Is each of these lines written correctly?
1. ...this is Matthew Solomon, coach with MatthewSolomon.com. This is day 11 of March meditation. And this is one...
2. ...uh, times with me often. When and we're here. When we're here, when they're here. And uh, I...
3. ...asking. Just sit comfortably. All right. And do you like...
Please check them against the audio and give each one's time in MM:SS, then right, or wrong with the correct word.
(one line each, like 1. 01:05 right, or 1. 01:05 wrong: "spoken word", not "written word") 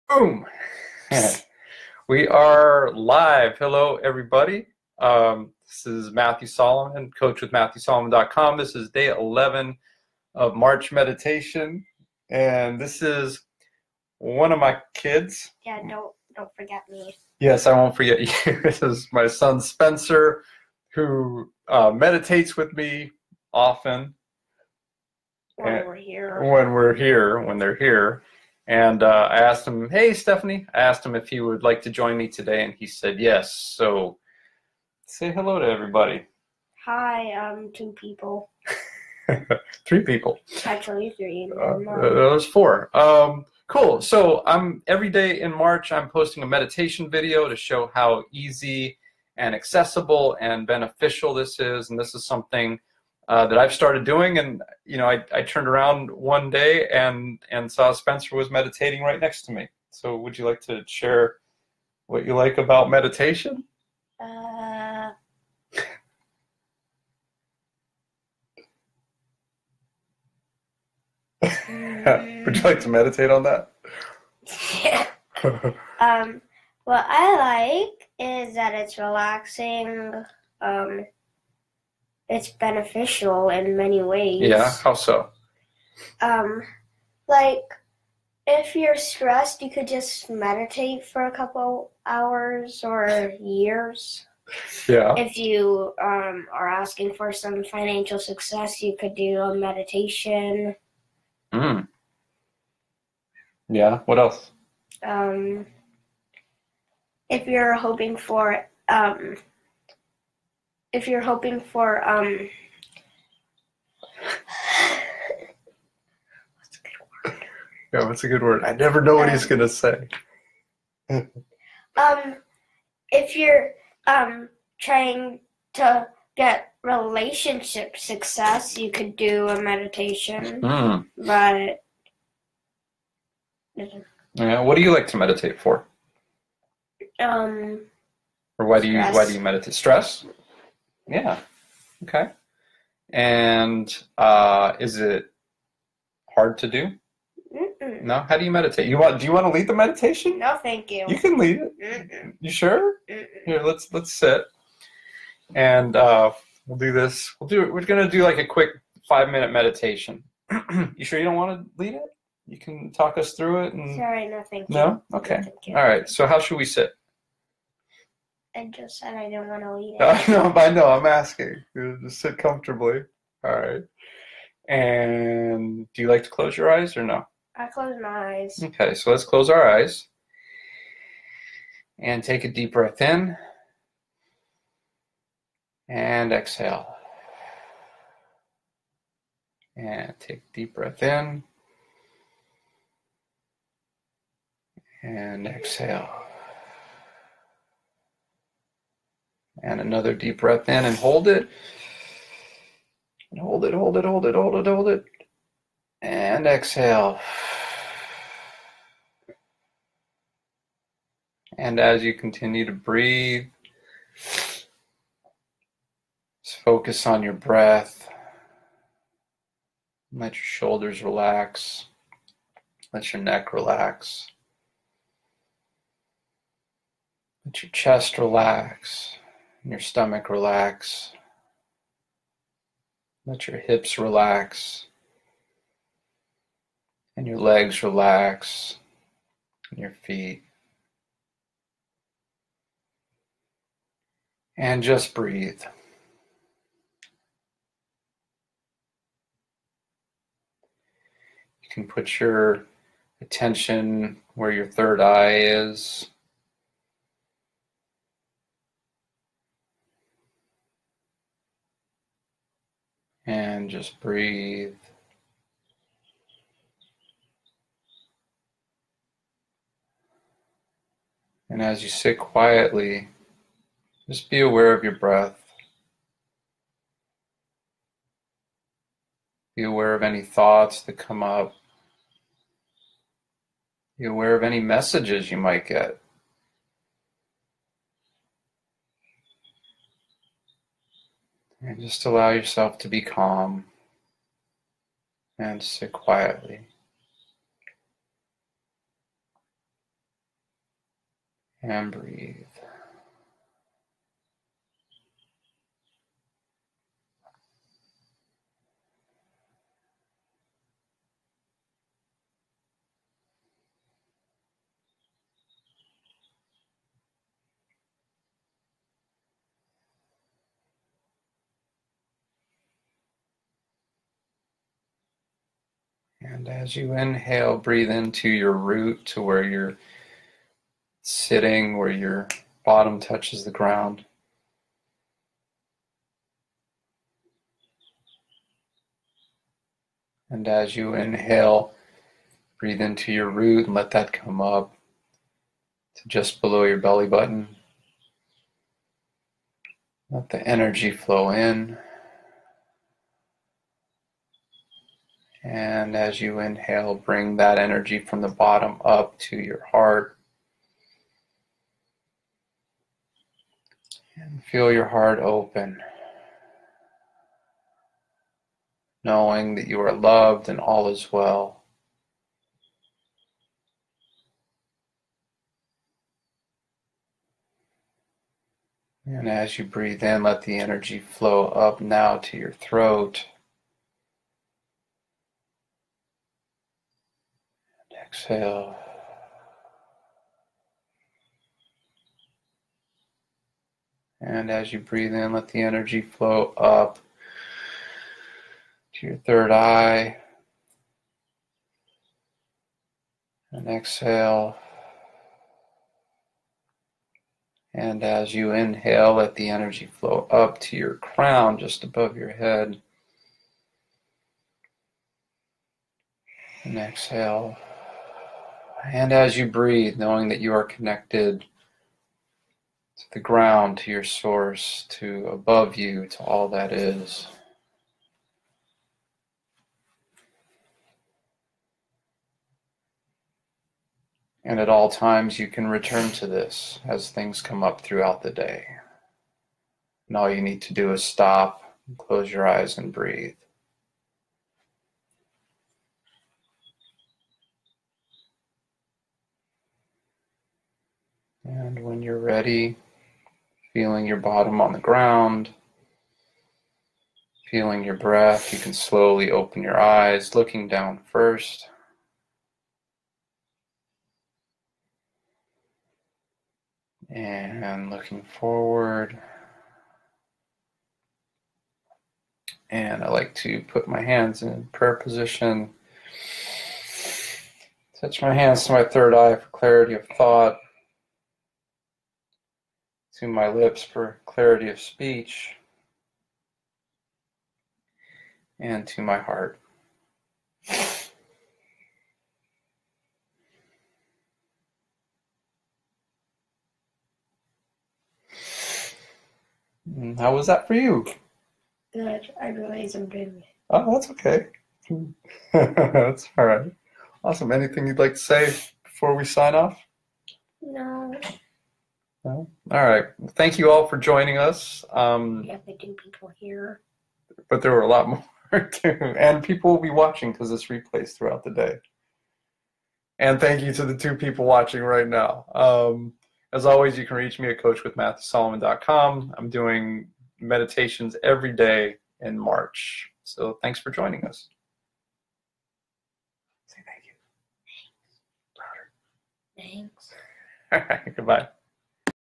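1. 00:05 right
2. 00:21 wrong: "meditates", not "times"
3. 02:51 right.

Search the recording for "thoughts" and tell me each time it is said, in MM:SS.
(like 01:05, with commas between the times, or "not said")
04:40, 08:00.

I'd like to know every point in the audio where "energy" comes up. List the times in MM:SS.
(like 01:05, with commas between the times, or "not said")
05:50, 05:57, 06:20, 06:35, 06:49.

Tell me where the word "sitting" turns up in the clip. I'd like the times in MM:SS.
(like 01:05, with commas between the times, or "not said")
05:31.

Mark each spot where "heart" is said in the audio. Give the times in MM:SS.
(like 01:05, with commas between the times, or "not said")
05:59, 06:04, 08:09.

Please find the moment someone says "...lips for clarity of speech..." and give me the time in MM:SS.
08:03.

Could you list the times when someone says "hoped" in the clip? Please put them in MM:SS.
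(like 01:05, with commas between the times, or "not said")
not said.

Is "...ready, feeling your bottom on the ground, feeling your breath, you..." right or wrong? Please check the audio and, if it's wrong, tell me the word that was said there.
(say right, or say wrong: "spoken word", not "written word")
right.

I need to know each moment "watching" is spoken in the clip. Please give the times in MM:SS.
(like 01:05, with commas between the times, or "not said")
08:39, 08:44.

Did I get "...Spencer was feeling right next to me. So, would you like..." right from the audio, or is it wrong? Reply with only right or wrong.
wrong.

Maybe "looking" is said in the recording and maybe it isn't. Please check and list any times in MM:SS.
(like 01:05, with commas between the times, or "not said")
07:40, 07:47.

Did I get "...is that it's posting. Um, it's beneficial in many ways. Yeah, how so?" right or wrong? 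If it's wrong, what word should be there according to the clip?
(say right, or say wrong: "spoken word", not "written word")
wrong: "relaxing", not "posting".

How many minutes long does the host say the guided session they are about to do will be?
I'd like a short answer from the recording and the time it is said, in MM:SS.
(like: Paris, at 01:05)
5, at 02:39.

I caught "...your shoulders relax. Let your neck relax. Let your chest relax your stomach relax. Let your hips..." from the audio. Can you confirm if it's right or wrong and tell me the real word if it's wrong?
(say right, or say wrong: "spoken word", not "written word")
right.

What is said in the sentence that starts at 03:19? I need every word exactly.
And another deep breath in and hold it.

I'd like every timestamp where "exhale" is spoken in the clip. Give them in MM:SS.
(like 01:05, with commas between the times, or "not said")
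03:06, 03:15, 03:26, 06:28, 06:43, 06:56.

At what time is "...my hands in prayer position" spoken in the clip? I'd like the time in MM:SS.
07:53.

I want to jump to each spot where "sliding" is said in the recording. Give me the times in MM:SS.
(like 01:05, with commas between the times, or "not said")
not said.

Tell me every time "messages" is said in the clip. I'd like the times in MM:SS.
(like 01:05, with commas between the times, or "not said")
04:44.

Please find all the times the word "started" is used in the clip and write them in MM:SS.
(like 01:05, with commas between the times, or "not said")
00:53.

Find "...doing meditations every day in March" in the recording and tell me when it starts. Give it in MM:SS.
08:49.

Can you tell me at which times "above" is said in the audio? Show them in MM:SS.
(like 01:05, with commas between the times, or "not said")
06:51, 07:05.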